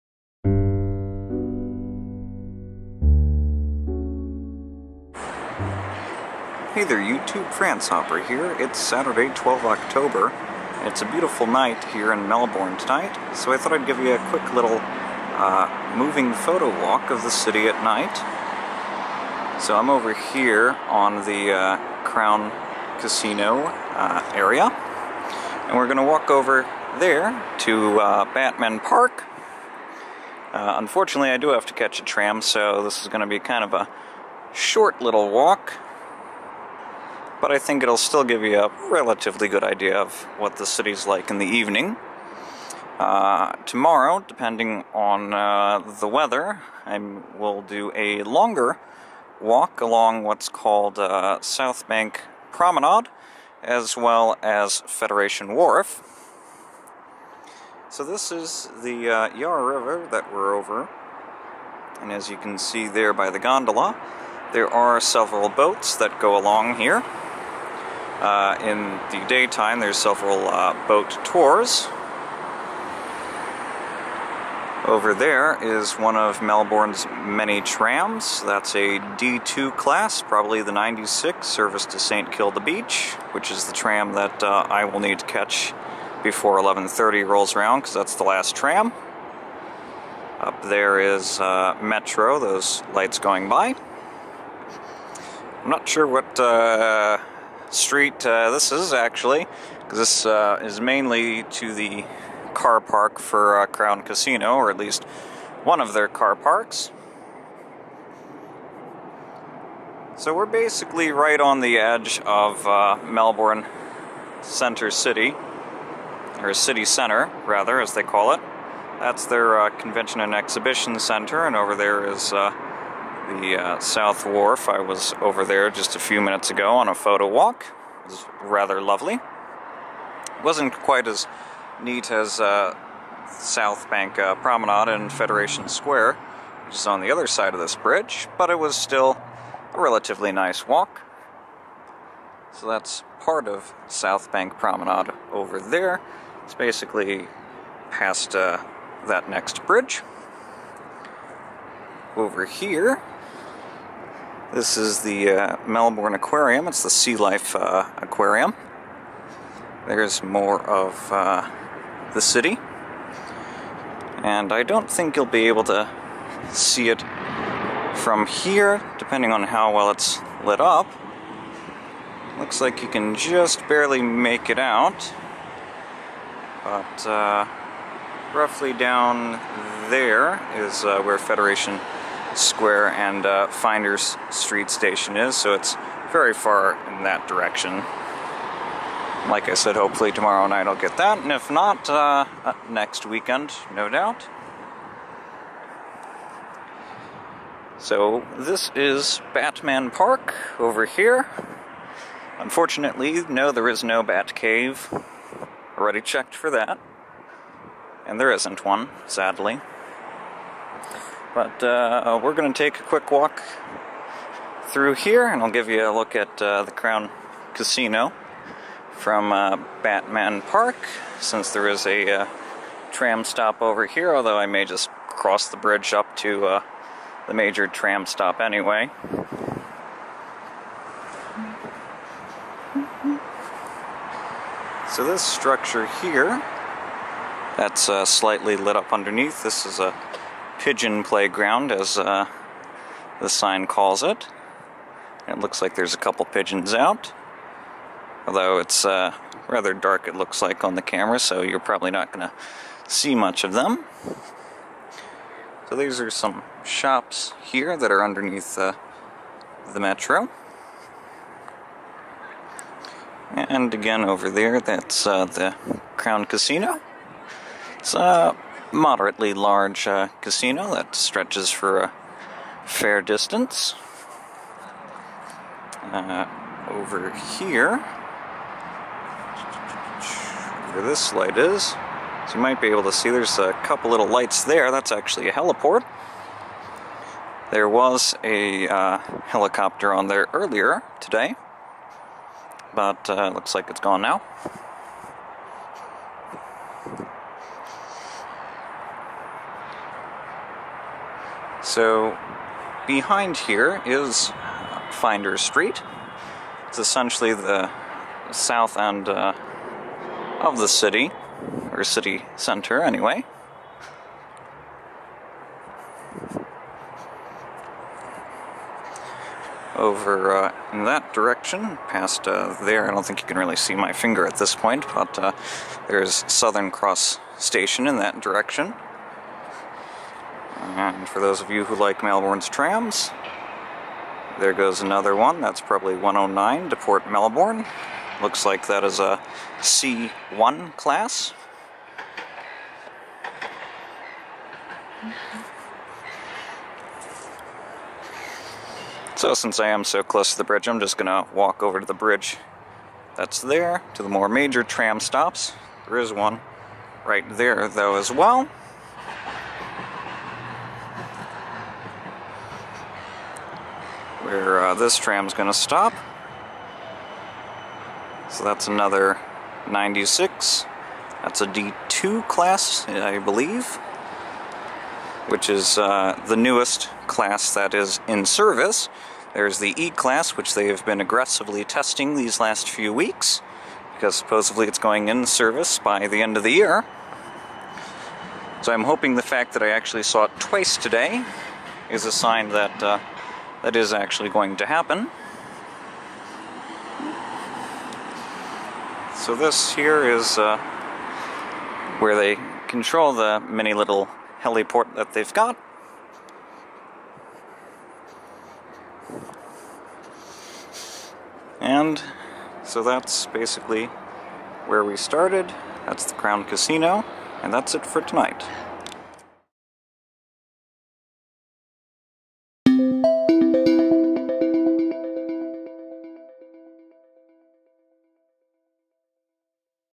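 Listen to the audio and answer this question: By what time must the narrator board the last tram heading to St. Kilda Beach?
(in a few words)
11:30.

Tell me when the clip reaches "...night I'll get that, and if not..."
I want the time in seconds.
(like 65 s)
190 s.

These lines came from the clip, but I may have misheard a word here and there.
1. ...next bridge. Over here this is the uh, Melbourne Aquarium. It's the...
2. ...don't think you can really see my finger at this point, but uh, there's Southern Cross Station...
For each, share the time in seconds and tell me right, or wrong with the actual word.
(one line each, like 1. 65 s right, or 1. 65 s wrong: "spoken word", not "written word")
1. 149 s right
2. 322 s right.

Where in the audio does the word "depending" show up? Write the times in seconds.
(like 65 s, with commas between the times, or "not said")
44 s, 168 s.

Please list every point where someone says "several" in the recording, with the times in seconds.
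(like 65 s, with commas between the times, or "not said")
65 s, 69 s.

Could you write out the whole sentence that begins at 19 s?
So I'm over here on the uh, Crown Casino uh, area, and we're going to walk over there to uh, Batman Park.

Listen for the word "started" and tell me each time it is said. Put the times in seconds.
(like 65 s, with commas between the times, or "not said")
414 s.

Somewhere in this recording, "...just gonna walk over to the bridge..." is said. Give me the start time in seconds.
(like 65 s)
350 s.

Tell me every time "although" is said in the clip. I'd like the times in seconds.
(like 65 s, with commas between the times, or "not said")
224 s, 248 s.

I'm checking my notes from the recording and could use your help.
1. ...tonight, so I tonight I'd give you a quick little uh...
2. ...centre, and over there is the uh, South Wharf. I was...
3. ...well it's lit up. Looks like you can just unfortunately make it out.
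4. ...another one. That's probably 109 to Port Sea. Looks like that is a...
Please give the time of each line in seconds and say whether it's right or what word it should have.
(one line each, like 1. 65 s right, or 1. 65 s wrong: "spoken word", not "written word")
1. 12 s wrong: "thought", not "tonight"
2. 120 s right
3. 169 s wrong: "barely", not "unfortunately"
4. 334 s wrong: "Melbourne", not "Sea".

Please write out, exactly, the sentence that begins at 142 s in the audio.
So that's part of South Bank Promenade over there.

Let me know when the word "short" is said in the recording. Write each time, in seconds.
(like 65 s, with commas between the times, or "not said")
34 s.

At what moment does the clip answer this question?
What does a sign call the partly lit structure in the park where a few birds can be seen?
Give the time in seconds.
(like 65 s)
240 s.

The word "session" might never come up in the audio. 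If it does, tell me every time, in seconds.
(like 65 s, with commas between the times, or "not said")
not said.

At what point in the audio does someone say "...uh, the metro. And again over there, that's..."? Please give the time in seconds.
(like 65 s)
258 s.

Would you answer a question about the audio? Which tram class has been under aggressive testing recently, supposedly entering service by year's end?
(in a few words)
E-class.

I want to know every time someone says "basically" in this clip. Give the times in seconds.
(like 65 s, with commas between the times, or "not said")
110 s, 146 s, 413 s.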